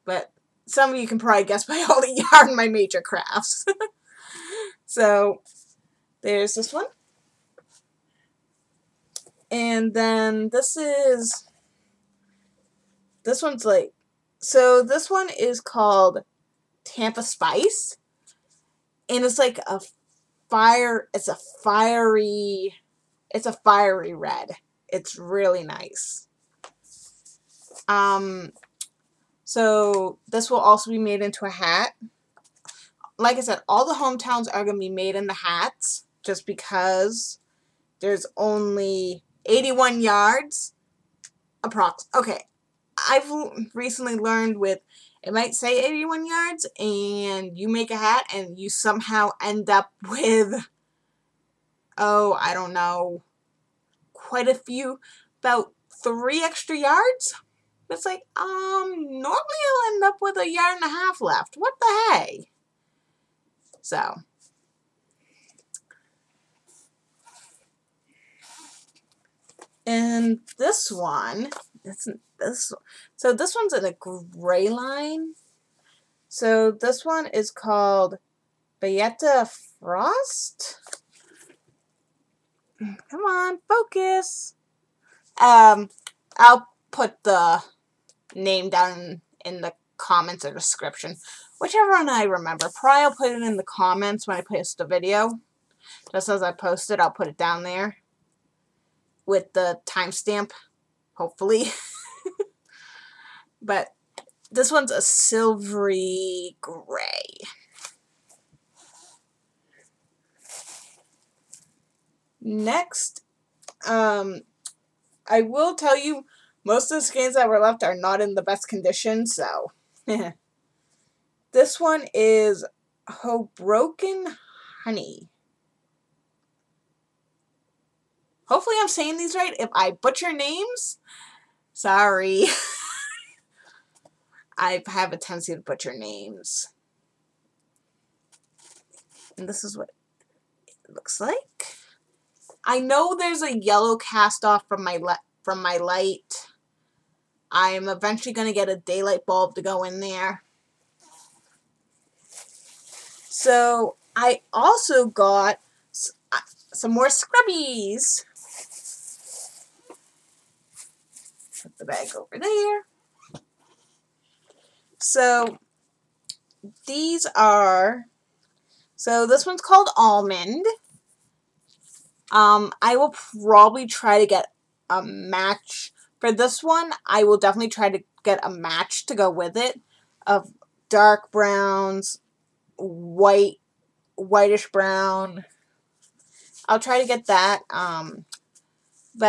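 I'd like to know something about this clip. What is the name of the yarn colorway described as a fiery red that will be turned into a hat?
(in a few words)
Tampa Spice.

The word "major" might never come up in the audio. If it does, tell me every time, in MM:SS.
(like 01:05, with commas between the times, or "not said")
00:02.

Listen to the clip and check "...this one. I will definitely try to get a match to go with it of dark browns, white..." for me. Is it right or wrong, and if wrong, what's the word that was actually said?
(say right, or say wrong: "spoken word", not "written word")
right.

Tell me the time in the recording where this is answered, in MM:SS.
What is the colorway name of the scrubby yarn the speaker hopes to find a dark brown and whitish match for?
02:49.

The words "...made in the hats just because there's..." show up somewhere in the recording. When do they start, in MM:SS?
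00:34.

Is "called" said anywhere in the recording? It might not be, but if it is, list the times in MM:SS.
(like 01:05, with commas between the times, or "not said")
00:15, 01:17, 02:49.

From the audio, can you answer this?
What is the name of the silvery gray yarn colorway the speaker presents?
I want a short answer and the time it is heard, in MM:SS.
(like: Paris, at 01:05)
Bayetta Frost, at 01:18.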